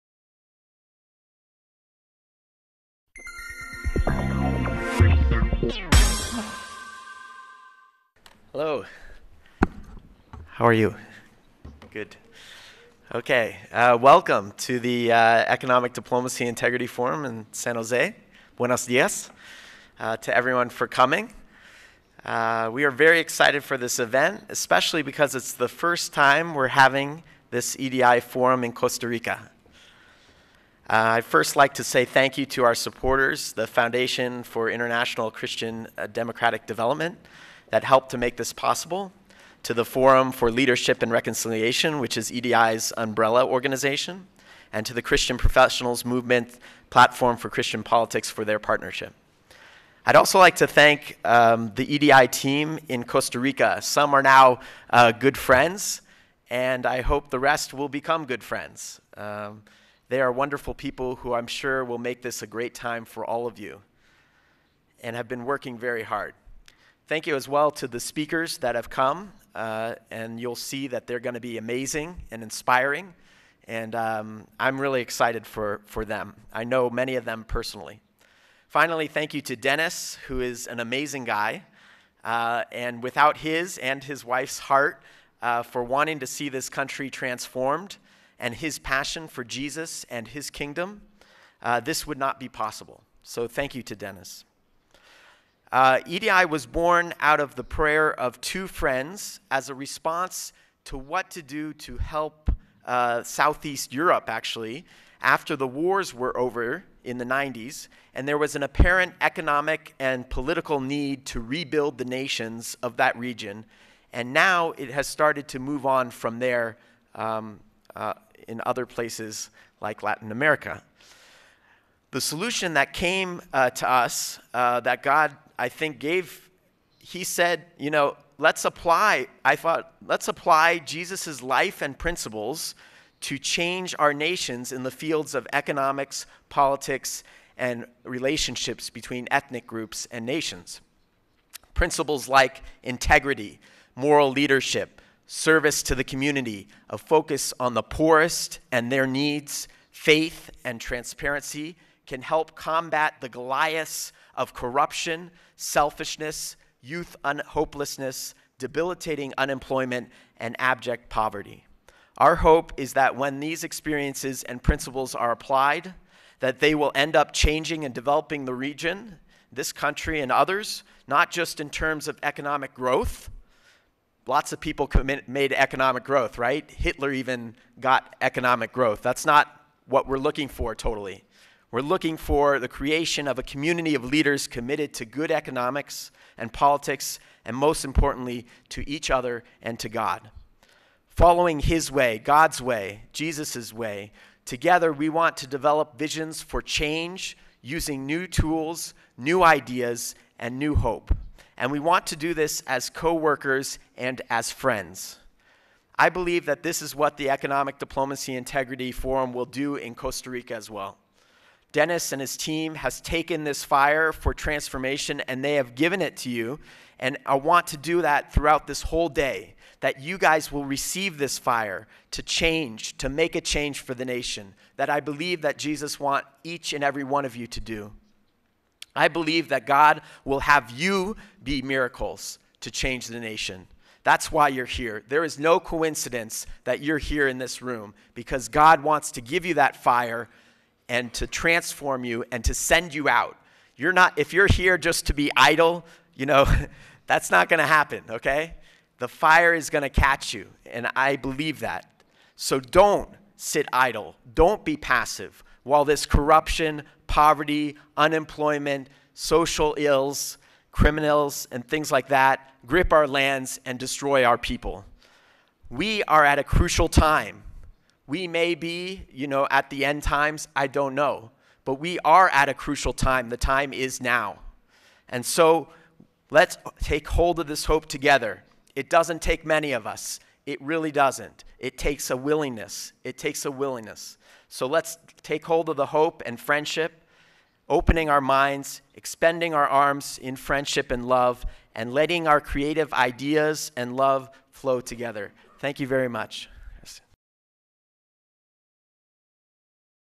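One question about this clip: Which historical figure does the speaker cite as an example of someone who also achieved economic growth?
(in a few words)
Hitler.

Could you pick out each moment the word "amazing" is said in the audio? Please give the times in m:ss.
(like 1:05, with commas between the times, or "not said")
1:11, 1:20.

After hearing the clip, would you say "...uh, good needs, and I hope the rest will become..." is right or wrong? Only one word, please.
wrong.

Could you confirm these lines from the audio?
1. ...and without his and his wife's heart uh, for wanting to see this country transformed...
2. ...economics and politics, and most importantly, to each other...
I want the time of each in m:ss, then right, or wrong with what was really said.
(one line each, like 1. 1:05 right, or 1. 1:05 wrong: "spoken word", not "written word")
1. 1:22 right
2. 3:05 right.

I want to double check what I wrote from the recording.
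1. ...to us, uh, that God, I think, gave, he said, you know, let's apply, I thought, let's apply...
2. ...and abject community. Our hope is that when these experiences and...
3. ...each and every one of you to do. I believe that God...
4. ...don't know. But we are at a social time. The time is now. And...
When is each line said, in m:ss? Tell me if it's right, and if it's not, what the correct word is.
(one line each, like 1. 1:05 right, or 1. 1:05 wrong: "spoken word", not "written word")
1. 2:03 right
2. 2:40 wrong: "poverty", not "community"
3. 3:46 right
4. 4:30 wrong: "crucial", not "social".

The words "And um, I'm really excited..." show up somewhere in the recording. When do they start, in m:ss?
1:13.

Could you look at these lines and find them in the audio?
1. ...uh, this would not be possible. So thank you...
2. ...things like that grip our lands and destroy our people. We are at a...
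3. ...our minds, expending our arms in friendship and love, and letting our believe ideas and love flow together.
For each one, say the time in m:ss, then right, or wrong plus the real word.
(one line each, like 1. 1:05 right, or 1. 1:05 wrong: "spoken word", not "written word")
1. 1:31 right
2. 4:21 right
3. 4:48 wrong: "creative", not "believe".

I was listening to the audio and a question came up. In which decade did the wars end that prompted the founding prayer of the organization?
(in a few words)
1990s.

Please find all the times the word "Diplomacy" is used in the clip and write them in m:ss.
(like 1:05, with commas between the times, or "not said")
0:15, 3:27.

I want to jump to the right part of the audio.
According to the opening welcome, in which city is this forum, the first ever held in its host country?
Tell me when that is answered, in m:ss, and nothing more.
0:17.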